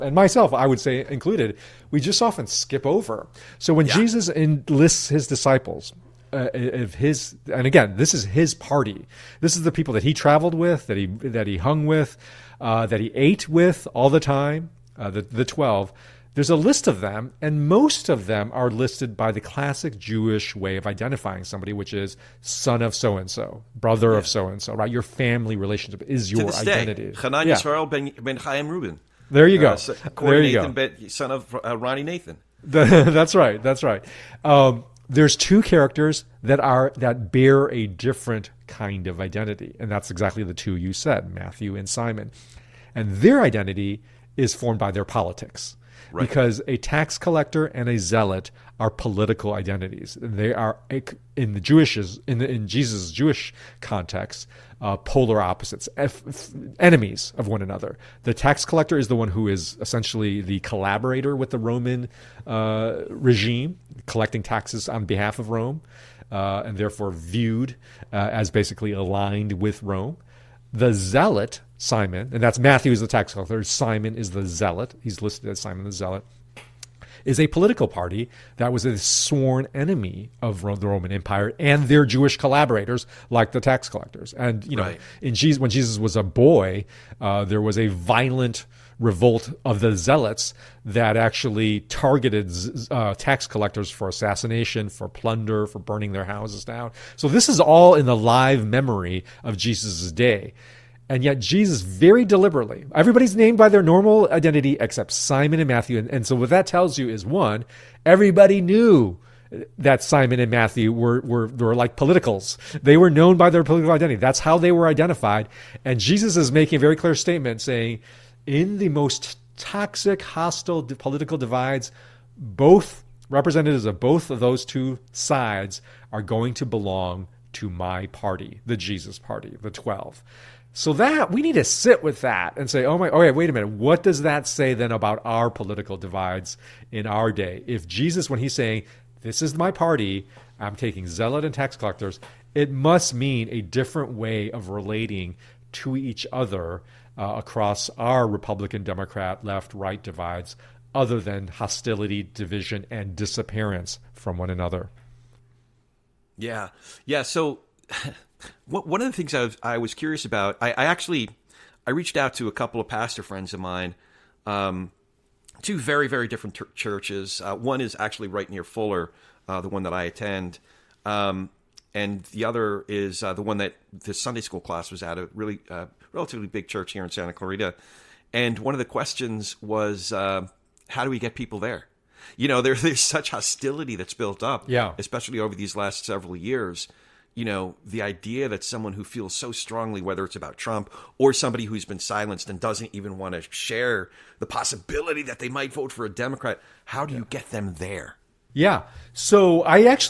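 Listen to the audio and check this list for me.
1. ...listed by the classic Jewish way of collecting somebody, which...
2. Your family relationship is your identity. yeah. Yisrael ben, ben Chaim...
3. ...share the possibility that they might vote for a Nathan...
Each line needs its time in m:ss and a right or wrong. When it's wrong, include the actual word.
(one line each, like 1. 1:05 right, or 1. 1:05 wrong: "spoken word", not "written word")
1. 0:18 wrong: "identifying", not "collecting"
2. 0:24 right
3. 3:13 wrong: "Democrat", not "Nathan".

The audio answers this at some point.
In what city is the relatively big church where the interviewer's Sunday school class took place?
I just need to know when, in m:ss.
2:57.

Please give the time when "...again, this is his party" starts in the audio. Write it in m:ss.
0:07.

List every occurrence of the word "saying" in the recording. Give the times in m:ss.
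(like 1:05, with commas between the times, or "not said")
1:57, 2:18.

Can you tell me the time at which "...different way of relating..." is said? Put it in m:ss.
2:23.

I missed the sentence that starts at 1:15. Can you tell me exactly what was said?
He's listed as Simon the zealot.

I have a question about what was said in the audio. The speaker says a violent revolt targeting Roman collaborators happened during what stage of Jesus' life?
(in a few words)
When Jesus was a boy.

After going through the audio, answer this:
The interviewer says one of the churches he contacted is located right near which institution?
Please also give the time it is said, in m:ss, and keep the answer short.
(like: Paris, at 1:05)
Fuller, at 2:48.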